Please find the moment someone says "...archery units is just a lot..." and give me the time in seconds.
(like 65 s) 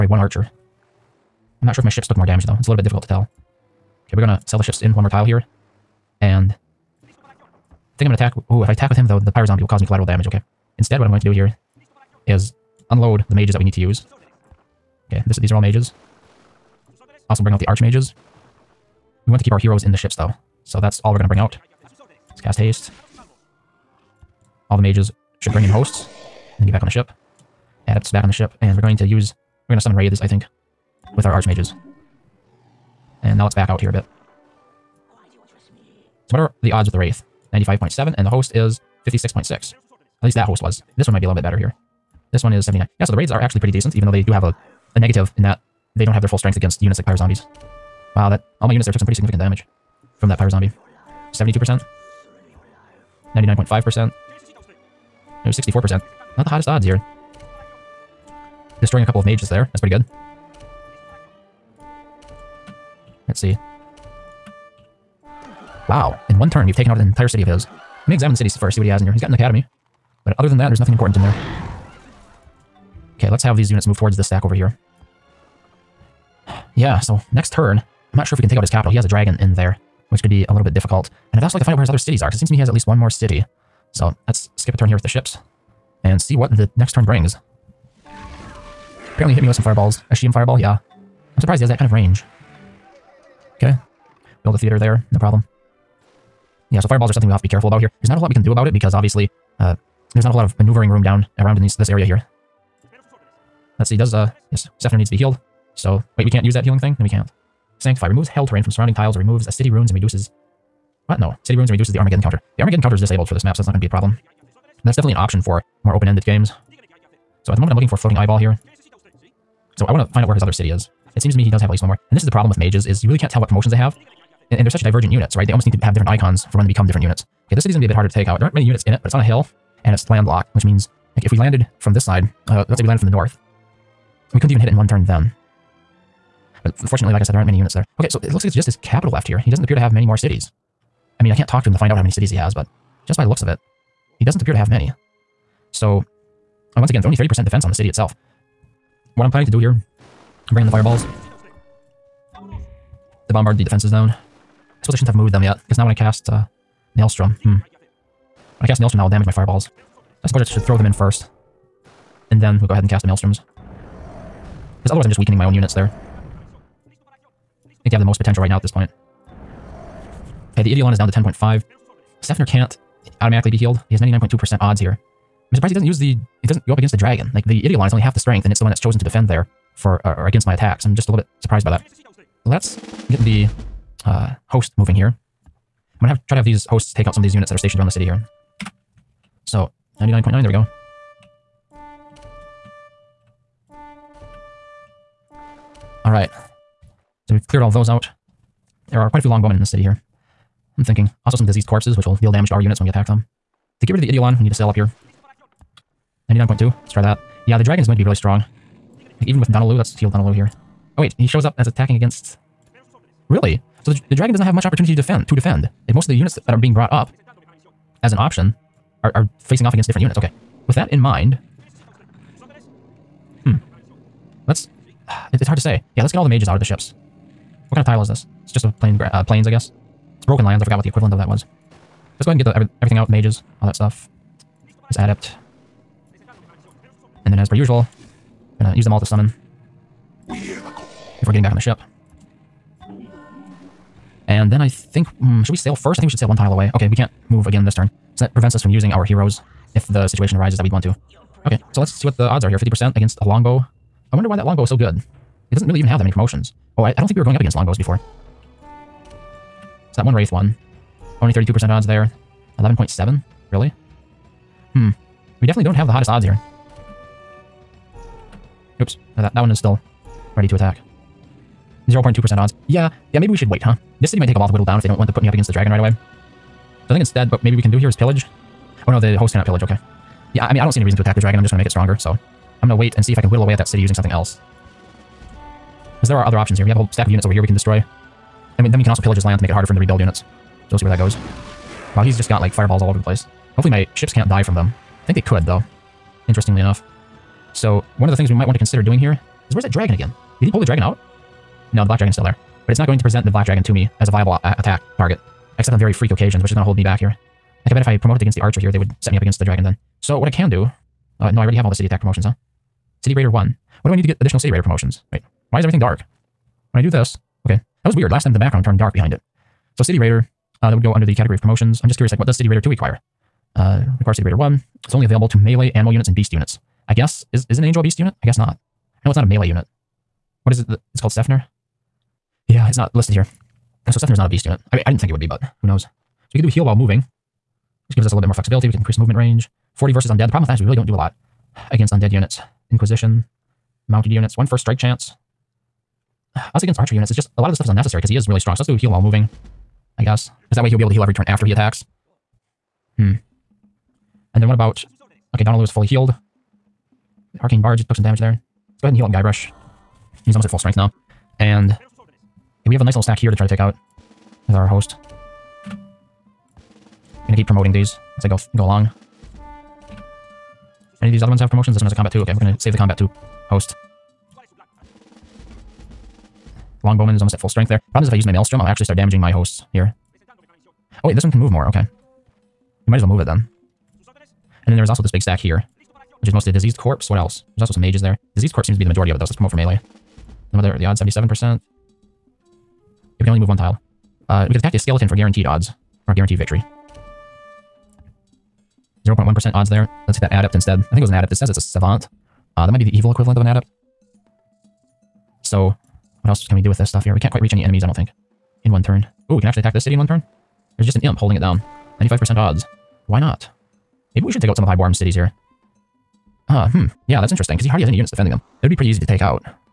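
346 s.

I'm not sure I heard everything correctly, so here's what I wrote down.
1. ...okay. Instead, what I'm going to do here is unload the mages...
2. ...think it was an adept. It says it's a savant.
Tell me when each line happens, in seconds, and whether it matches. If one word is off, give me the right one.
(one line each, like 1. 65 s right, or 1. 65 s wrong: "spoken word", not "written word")
1. 10 s right
2. 400 s right.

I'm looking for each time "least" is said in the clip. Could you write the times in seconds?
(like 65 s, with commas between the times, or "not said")
40 s, 82 s, 121 s.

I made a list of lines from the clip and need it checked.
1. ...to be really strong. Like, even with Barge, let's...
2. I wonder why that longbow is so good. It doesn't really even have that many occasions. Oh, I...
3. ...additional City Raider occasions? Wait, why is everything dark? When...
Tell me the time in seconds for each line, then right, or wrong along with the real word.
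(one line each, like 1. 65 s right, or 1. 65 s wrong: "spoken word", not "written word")
1. 207 s wrong: "Donaloo", not "Barge"
2. 254 s wrong: "promotions", not "occasions"
3. 314 s wrong: "promotions", not "occasions".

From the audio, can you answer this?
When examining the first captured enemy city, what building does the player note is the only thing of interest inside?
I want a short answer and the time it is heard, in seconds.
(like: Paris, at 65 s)
An academy, at 69 s.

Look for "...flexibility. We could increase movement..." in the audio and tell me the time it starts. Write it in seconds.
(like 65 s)
338 s.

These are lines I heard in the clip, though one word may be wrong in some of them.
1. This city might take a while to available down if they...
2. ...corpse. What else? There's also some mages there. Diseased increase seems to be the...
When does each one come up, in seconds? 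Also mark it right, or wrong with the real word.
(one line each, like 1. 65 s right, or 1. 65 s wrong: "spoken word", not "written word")
1. 274 s wrong: "whittle", not "available"
2. 386 s wrong: "corpse", not "increase".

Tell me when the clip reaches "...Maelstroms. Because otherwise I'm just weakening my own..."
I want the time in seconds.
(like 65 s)
163 s.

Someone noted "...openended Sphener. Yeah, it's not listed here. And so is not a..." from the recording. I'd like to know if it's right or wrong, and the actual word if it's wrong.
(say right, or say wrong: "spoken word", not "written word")
wrong: "called", not "openended".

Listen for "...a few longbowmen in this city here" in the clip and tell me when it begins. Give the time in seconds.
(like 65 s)
199 s.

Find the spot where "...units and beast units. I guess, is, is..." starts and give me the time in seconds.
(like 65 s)
325 s.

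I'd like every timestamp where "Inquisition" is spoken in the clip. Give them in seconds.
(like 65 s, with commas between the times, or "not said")
342 s.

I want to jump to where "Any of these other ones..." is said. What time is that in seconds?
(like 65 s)
371 s.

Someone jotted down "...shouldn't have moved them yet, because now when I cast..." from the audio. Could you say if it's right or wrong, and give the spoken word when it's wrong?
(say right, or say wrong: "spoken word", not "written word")
right.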